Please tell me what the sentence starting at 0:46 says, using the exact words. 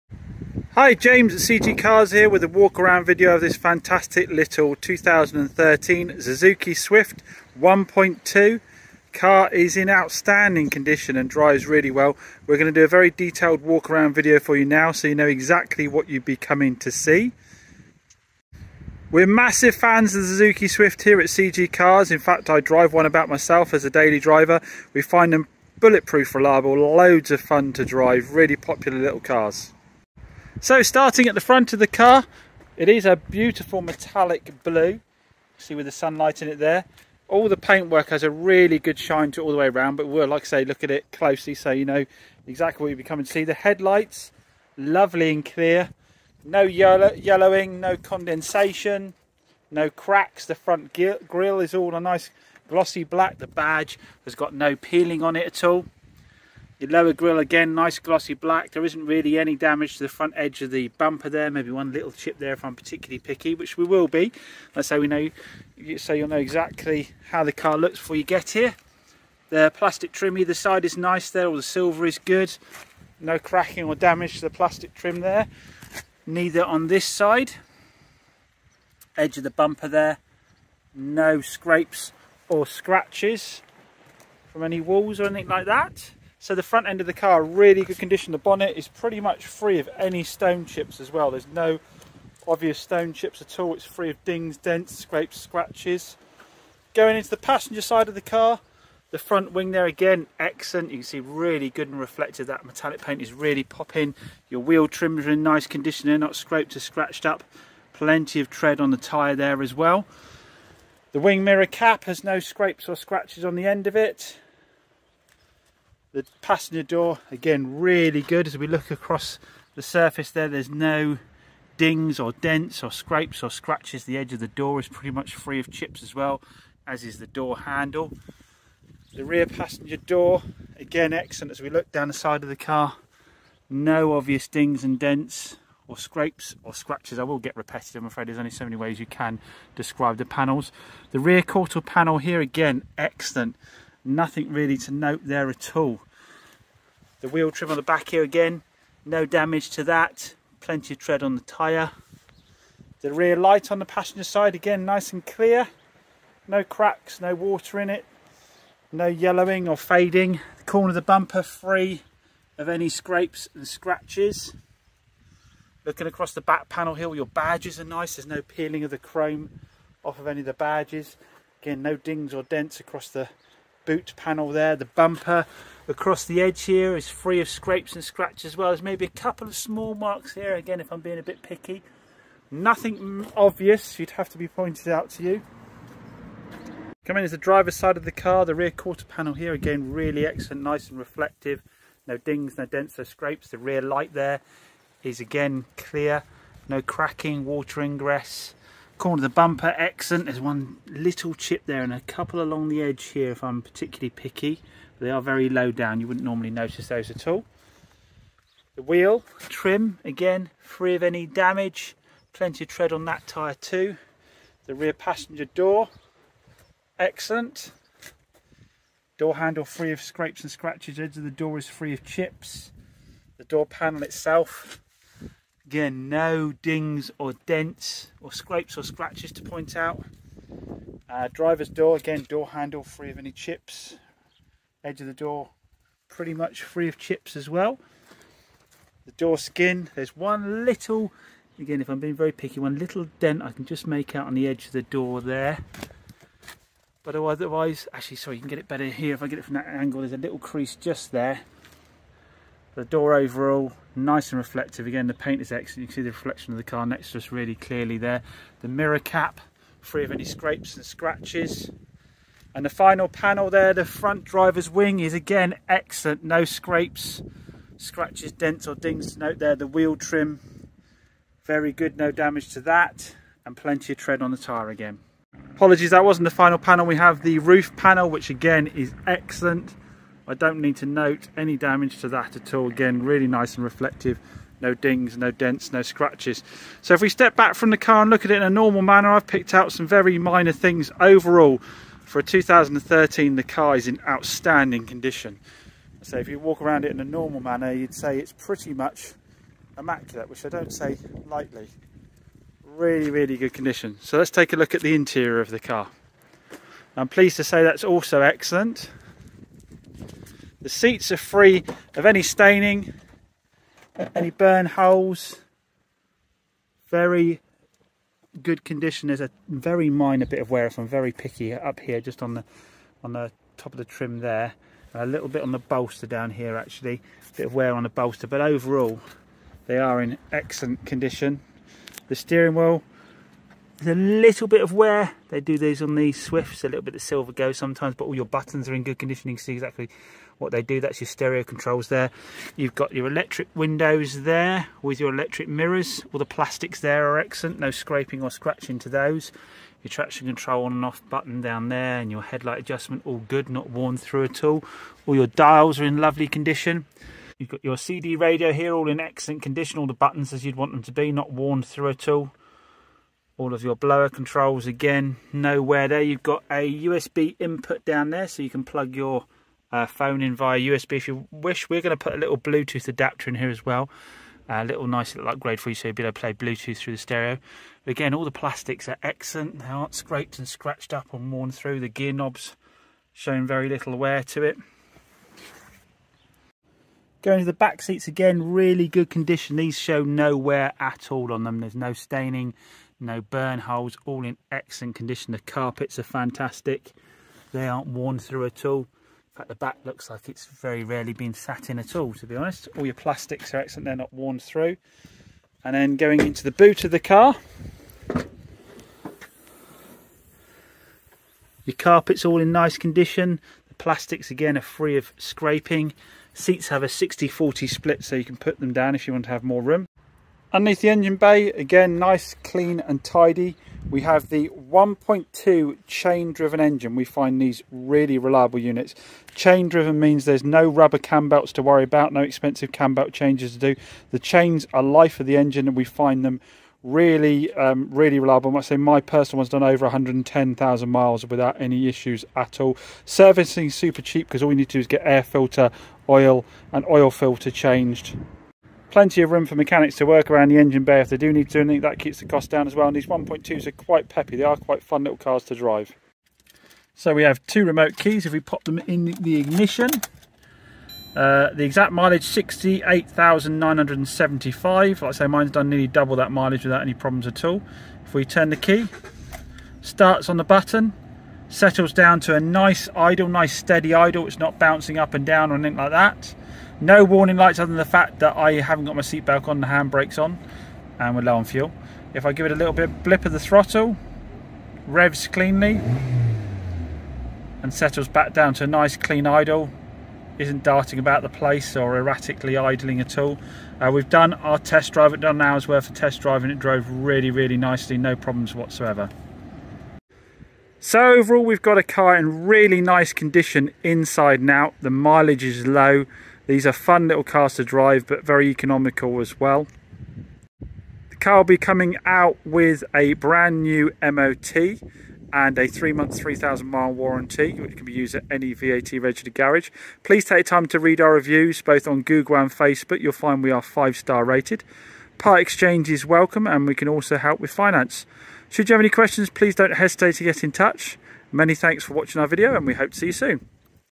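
No yellow, yellowing, no condensation, no cracks.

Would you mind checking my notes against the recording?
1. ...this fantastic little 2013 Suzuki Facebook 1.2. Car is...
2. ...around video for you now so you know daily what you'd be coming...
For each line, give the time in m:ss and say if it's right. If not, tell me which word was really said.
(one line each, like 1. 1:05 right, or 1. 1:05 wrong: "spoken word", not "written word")
1. 0:03 wrong: "Swift", not "Facebook"
2. 0:13 wrong: "exactly", not "daily".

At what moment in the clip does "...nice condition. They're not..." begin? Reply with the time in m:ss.
1:45.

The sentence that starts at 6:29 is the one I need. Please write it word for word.
These show no wear at all on them.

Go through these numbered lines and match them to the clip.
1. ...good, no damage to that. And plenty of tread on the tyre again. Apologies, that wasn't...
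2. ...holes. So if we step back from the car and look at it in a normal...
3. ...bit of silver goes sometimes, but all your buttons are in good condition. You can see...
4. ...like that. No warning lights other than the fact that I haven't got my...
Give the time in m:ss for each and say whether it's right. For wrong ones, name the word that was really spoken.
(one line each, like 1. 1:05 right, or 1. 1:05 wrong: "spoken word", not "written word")
1. 4:31 right
2. 4:45 wrong: "scratches", not "holes"
3. 5:36 right
4. 7:55 right.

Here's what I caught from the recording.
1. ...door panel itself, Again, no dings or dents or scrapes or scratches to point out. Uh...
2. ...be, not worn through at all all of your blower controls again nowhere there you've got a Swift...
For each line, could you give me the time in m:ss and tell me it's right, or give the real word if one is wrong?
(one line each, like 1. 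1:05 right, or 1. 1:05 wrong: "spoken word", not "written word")
1. 3:43 right
2. 6:00 wrong: "USB", not "Swift".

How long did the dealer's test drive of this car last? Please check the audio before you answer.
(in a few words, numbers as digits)
an hour.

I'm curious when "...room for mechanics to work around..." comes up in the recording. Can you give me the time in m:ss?
7:29.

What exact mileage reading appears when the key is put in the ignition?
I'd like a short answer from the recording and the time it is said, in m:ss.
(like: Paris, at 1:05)
68,975, at 7:42.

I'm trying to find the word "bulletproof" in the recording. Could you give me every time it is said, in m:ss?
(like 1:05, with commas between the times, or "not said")
0:25.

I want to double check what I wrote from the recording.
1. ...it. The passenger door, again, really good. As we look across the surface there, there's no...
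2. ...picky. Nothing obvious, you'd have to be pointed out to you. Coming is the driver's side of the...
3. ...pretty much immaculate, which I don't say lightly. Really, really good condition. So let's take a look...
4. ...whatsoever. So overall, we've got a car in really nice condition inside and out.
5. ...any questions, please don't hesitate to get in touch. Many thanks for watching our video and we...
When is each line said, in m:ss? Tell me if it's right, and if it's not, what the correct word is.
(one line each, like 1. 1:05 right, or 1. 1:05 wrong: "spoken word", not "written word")
1. 1:53 right
2. 3:01 right
3. 4:58 right
4. 8:18 right
5. 8:48 right.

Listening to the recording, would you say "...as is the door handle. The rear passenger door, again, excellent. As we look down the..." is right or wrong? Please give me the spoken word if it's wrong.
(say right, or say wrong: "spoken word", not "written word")
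right.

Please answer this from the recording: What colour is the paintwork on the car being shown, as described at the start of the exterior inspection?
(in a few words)
metallic blue.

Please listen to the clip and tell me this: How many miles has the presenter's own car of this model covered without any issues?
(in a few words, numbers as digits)
110,000.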